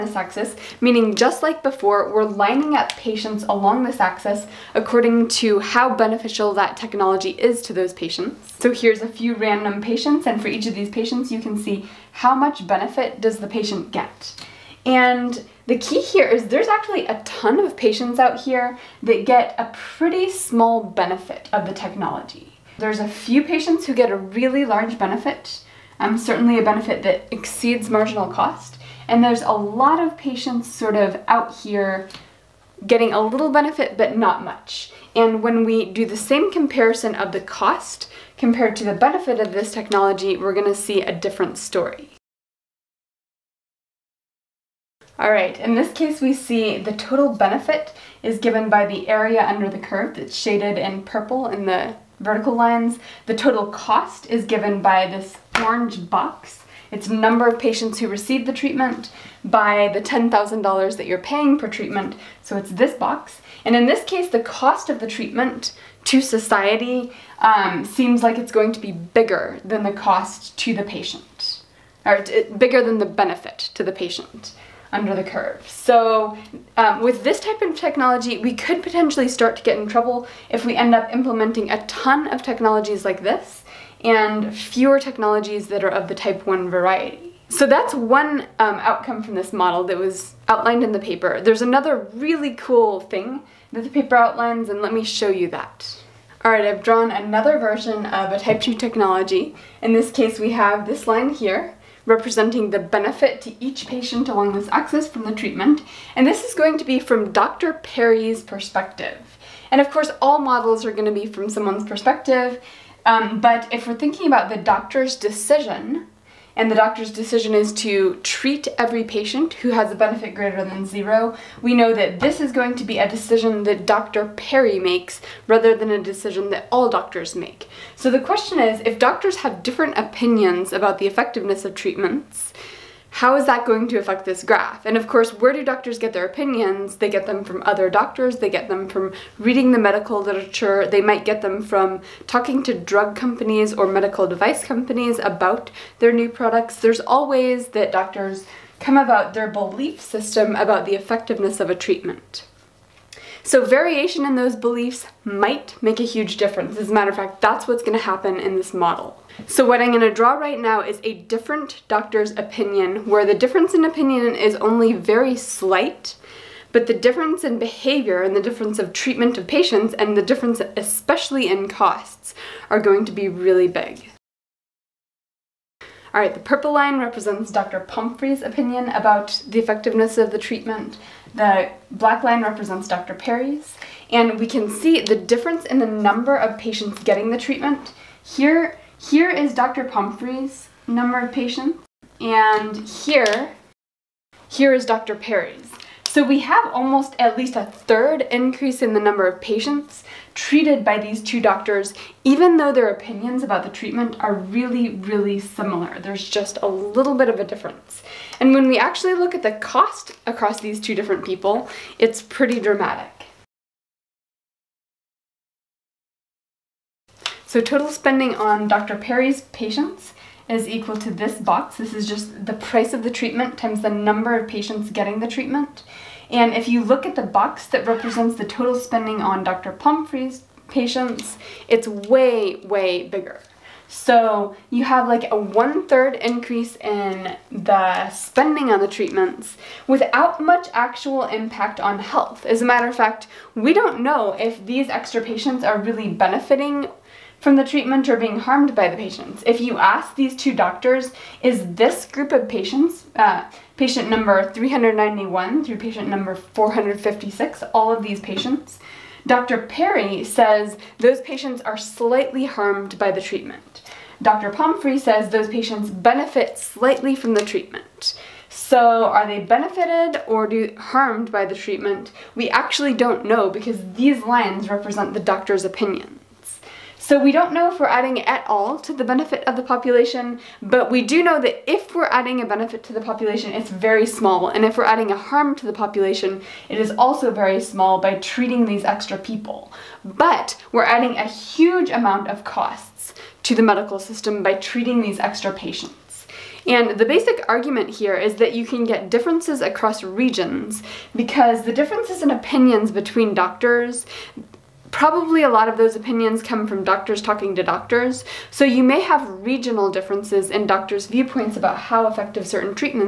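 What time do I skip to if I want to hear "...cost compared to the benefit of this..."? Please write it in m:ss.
0:37.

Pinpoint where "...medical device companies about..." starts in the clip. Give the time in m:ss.
2:23.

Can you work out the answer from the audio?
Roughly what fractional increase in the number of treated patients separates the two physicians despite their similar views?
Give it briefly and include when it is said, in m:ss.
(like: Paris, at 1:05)
a third, at 3:17.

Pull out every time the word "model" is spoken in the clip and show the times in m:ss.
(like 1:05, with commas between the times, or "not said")
1:29, 1:50, 2:38.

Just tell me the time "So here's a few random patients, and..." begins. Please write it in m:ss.
0:08.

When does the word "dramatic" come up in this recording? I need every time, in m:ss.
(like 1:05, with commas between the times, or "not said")
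3:32.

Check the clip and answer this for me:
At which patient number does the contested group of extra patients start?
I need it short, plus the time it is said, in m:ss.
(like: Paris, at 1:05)
391, at 4:14.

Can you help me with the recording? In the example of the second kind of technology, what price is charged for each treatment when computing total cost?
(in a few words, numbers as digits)
$10,000.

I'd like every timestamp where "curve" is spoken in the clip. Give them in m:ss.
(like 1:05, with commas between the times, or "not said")
0:49, 1:15.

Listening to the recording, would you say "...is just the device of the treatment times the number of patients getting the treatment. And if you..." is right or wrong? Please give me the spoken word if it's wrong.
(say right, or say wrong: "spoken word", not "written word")
wrong: "price", not "device".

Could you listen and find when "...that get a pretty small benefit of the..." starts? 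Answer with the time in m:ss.
0:19.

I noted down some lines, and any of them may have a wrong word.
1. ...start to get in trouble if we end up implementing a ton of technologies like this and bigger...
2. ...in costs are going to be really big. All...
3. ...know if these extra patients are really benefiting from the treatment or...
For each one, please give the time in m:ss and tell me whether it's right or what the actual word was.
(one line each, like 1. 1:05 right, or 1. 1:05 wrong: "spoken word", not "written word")
1. 1:19 wrong: "fewer", not "bigger"
2. 2:51 right
3. 4:04 right.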